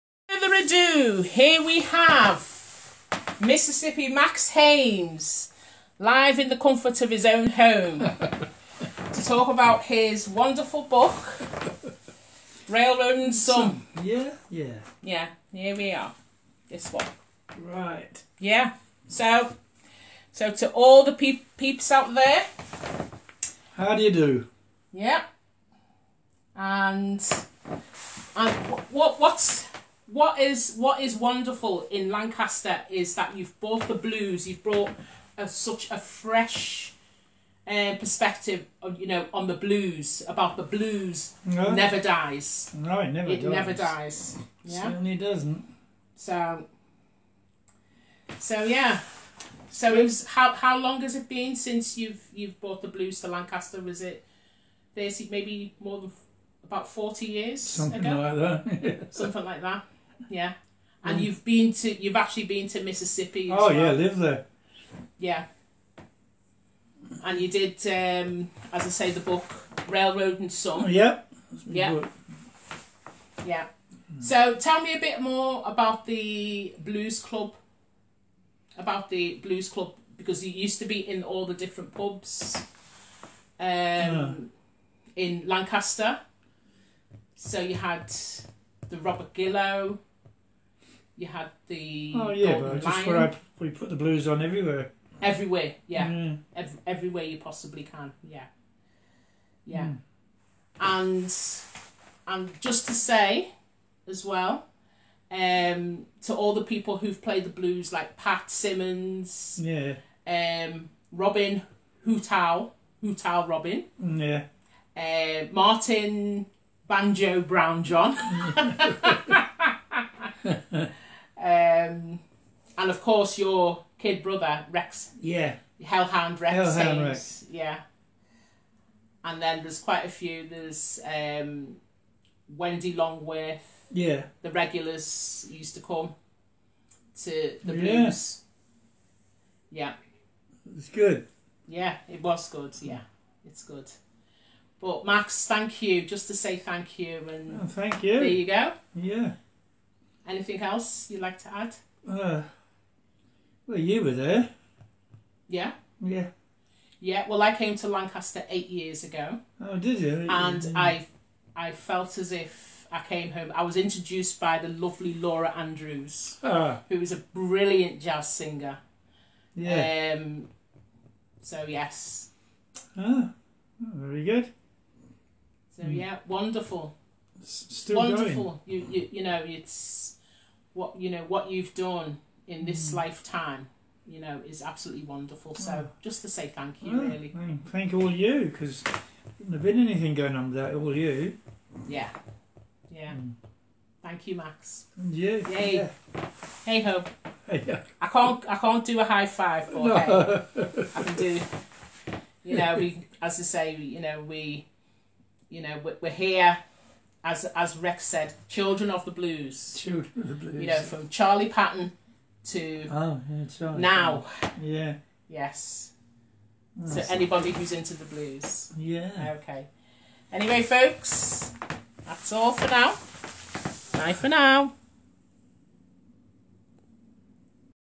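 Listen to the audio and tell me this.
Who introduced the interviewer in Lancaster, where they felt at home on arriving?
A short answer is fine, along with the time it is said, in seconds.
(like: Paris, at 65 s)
Laura Andrews, at 165 s.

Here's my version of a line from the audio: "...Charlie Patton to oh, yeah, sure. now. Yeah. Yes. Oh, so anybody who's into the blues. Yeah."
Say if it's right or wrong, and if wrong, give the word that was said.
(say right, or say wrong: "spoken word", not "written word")
right.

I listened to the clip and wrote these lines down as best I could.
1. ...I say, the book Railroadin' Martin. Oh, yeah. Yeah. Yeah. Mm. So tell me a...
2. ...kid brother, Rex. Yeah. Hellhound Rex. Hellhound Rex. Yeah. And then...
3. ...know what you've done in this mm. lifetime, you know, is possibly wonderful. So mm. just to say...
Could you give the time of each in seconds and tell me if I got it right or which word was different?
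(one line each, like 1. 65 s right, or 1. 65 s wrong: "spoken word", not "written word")
1. 68 s wrong: "Some", not "Martin"
2. 123 s right
3. 181 s wrong: "absolutely", not "possibly".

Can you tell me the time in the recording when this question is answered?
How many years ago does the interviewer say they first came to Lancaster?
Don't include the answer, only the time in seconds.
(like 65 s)
158 s.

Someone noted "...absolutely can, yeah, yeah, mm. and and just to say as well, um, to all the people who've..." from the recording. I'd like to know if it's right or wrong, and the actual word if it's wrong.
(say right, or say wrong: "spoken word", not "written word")
wrong: "possibly", not "absolutely".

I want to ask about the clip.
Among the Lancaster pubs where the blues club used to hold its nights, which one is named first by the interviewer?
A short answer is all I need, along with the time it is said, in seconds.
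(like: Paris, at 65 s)
Robert Gillow, at 88 s.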